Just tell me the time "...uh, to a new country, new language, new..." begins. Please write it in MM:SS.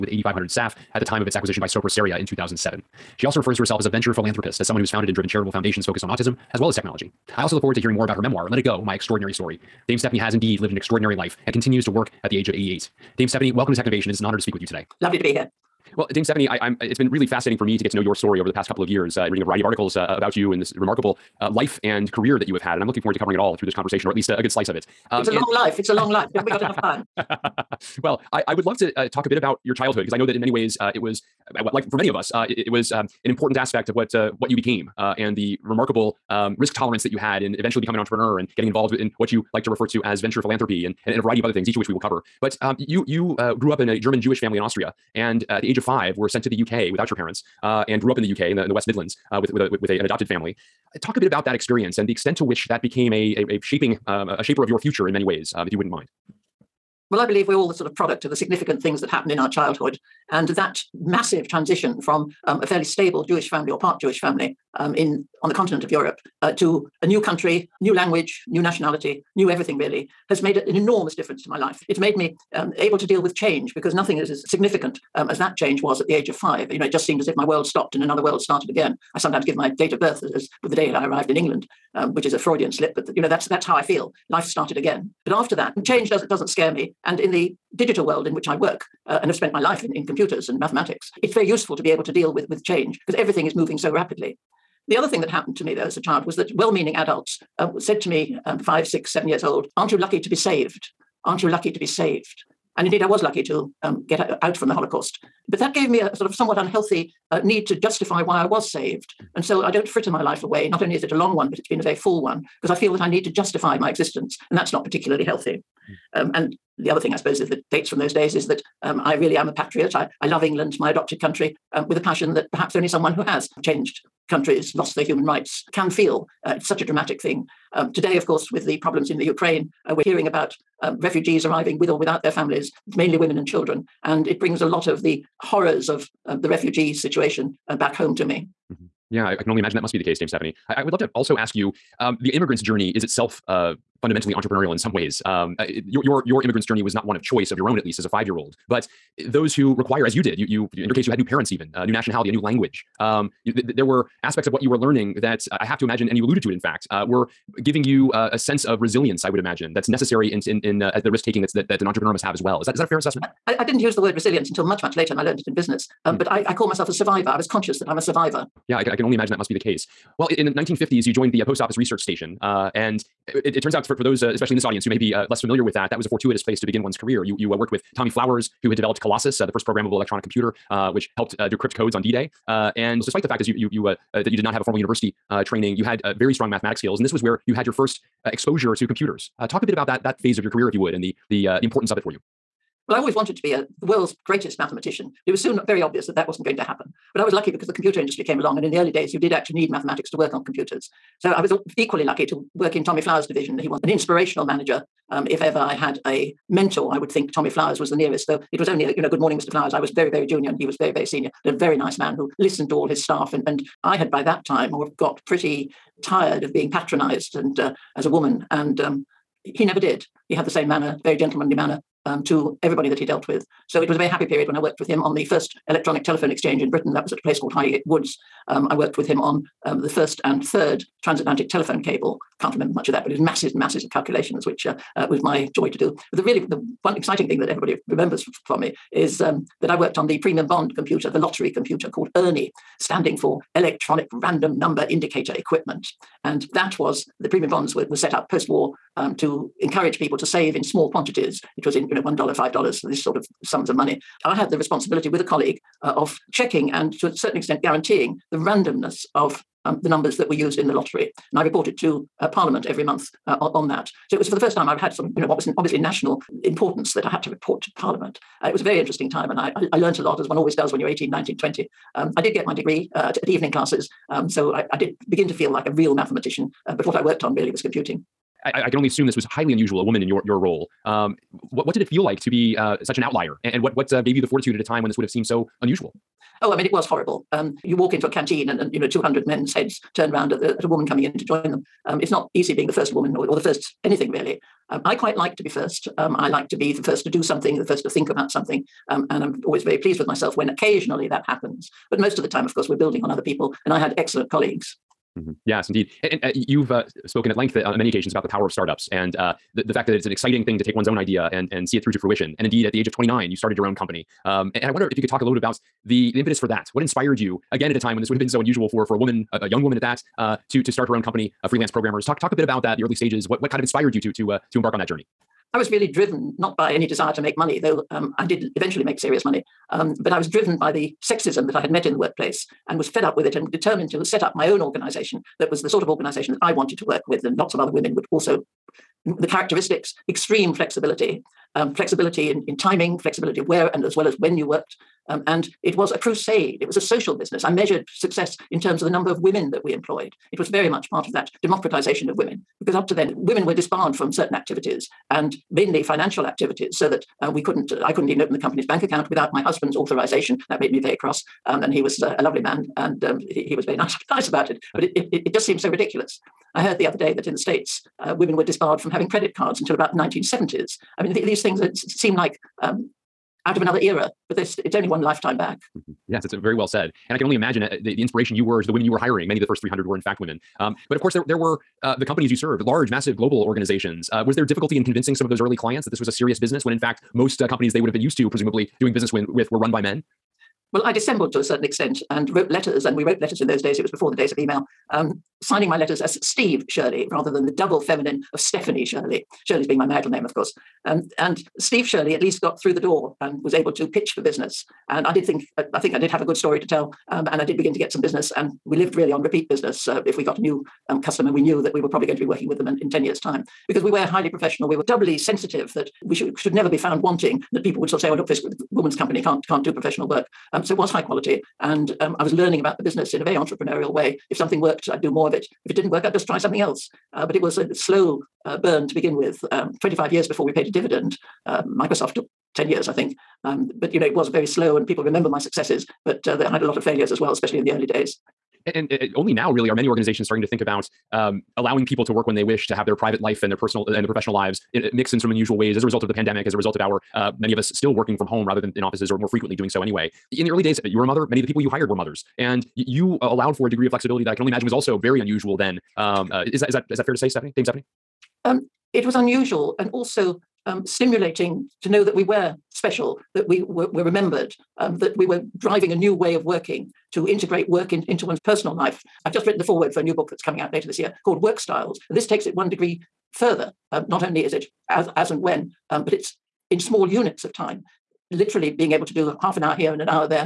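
01:06.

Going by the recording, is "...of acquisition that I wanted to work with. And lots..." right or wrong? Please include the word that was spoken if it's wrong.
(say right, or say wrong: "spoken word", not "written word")
wrong: "organization", not "acquisition".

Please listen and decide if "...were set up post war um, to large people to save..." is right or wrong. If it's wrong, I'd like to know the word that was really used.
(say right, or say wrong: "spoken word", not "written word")
wrong: "encourage", not "large".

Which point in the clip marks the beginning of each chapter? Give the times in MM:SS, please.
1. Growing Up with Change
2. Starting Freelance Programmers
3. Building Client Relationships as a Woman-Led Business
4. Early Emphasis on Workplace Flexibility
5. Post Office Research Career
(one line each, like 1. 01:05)
1. 00:15
2. 05:05
3. 06:15
4. 07:19
5. 02:48.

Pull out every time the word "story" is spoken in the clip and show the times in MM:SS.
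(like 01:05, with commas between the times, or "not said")
00:09, 00:18, 06:46.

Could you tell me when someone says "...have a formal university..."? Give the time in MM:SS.
03:04.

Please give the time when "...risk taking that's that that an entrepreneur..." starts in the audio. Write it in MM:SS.
02:41.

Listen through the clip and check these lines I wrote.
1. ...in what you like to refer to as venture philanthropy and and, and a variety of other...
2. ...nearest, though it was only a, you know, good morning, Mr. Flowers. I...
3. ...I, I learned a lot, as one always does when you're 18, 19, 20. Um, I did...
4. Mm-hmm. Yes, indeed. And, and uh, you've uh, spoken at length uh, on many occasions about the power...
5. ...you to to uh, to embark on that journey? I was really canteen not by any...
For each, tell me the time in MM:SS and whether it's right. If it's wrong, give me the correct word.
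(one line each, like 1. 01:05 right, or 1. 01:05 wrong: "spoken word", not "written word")
1. 00:38 right
2. 03:27 right
3. 04:29 right
4. 05:05 right
5. 05:23 wrong: "driven", not "canteen".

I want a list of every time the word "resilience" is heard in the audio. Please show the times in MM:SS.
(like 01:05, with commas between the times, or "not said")
02:38, 02:44.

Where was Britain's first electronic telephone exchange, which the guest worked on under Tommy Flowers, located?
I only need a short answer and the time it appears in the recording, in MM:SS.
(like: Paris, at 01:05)
High Woods, at 03:47.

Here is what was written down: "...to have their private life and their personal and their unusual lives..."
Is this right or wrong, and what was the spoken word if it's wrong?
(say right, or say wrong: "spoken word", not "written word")
wrong: "professional", not "unusual".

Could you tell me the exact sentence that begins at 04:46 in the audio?
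Oh, I mean, it was horrible.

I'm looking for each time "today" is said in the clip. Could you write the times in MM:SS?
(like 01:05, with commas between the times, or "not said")
00:14, 02:07.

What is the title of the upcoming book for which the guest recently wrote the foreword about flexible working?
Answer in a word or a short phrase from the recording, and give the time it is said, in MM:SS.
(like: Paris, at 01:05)
Work Styles, at 07:51.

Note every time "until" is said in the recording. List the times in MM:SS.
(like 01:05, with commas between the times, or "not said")
02:44, 06:09.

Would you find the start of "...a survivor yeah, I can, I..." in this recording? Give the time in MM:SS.
02:47.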